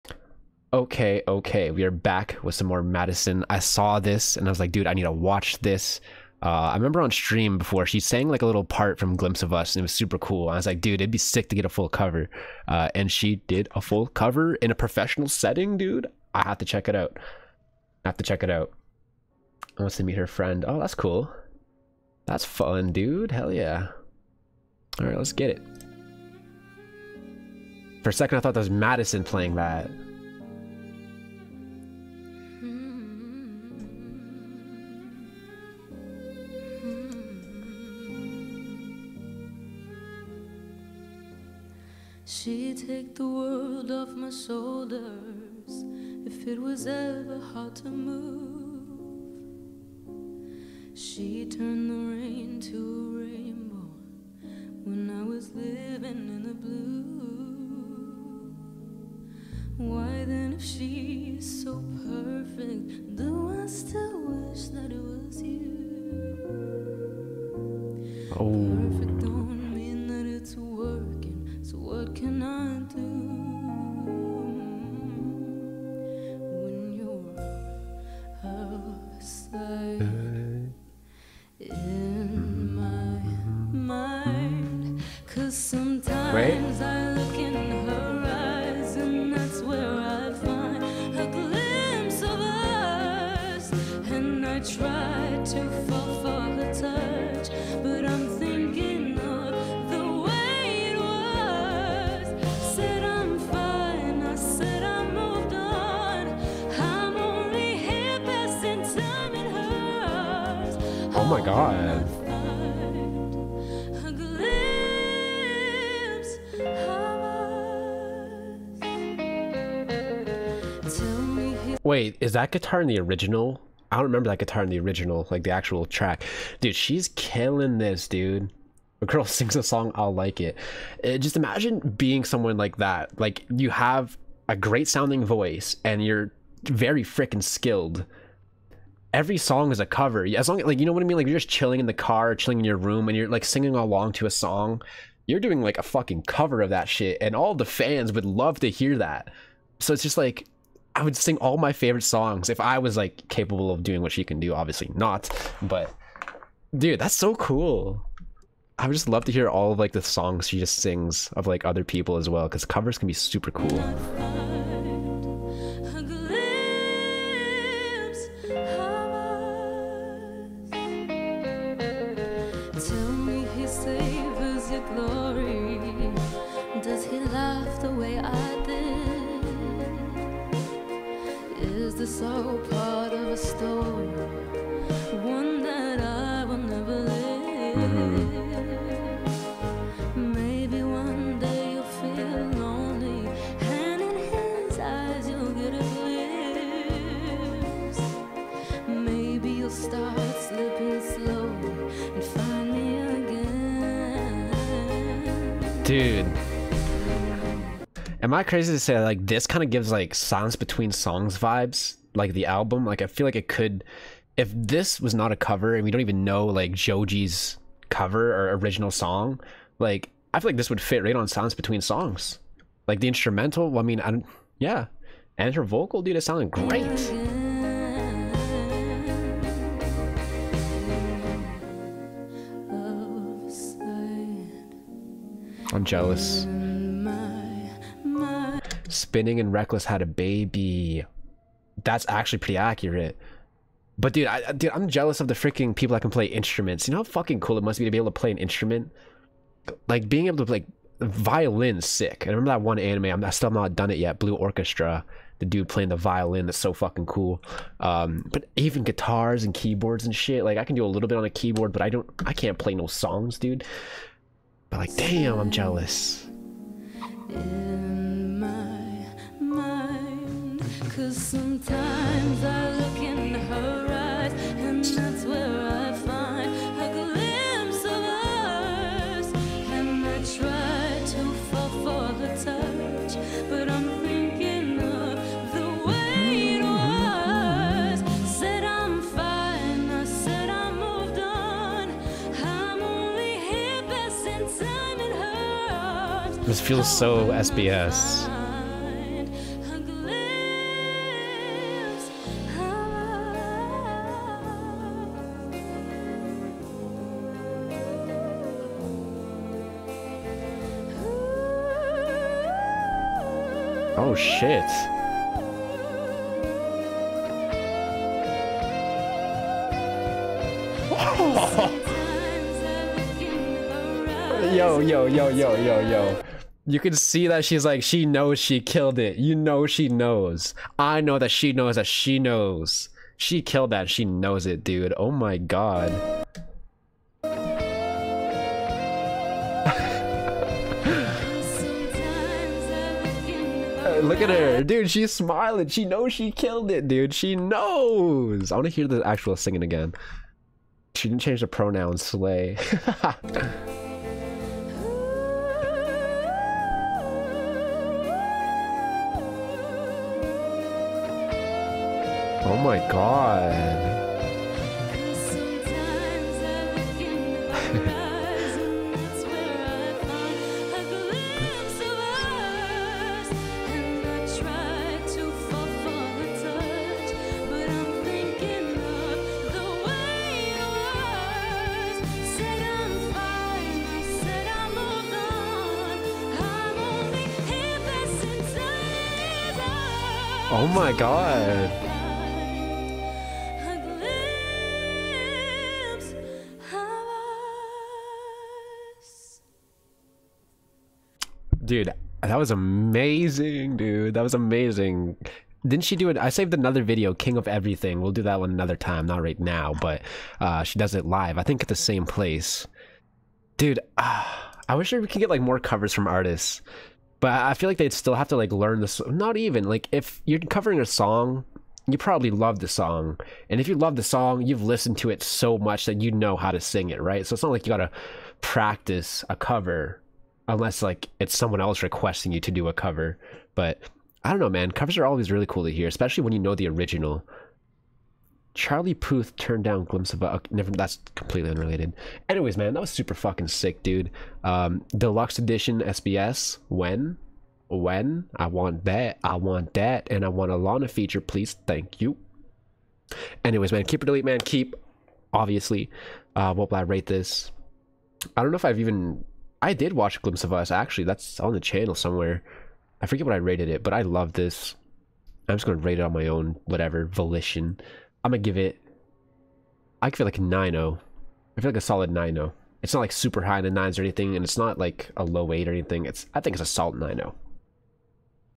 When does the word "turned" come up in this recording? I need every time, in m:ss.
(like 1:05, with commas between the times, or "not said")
0:51, 7:19.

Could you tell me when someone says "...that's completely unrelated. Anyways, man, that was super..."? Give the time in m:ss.
7:20.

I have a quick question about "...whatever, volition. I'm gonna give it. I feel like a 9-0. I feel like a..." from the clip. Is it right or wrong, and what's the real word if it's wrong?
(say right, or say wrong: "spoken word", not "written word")
right.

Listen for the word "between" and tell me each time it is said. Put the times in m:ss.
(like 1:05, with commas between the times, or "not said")
3:30, 3:41.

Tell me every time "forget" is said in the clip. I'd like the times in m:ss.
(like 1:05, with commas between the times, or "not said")
7:43.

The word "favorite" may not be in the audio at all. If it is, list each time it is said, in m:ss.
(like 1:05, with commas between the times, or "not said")
2:31.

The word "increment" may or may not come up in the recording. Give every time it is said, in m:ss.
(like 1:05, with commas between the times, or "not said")
not said.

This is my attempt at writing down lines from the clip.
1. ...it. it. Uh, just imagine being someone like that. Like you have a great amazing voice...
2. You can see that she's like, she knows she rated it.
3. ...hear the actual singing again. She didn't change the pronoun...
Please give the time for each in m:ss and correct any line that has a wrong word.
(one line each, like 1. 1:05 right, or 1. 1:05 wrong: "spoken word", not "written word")
1. 2:10 wrong: "sounding", not "amazing"
2. 5:26 wrong: "killed", not "rated"
3. 5:48 right.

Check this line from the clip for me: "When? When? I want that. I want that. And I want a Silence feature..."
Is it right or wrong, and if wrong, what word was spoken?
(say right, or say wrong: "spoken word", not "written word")
wrong: "Lana", not "Silence".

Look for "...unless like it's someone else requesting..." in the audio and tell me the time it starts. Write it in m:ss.
7:10.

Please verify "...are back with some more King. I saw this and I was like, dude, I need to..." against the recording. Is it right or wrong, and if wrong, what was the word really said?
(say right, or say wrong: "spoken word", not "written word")
wrong: "Madison", not "King".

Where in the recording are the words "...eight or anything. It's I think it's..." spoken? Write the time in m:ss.
7:55.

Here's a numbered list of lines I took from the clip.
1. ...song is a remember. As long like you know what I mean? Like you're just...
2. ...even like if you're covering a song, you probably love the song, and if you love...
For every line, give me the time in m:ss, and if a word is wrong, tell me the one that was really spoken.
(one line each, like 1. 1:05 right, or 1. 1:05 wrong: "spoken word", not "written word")
1. 2:19 wrong: "cover", not "remember"
2. 6:59 right.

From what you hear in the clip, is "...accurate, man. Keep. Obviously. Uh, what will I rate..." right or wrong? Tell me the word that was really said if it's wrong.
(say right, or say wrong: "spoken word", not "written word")
wrong: "delete", not "accurate".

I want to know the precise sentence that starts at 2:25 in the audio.
You're doing like a fucking cover of that shit, and all the fans would love to hear that.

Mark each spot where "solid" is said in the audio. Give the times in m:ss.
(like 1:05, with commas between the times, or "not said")
7:51, 7:56.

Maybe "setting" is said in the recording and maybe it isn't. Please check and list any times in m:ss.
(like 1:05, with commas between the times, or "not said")
0:15.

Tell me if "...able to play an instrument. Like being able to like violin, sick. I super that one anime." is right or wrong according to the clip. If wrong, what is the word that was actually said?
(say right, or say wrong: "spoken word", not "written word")
wrong: "remember", not "super".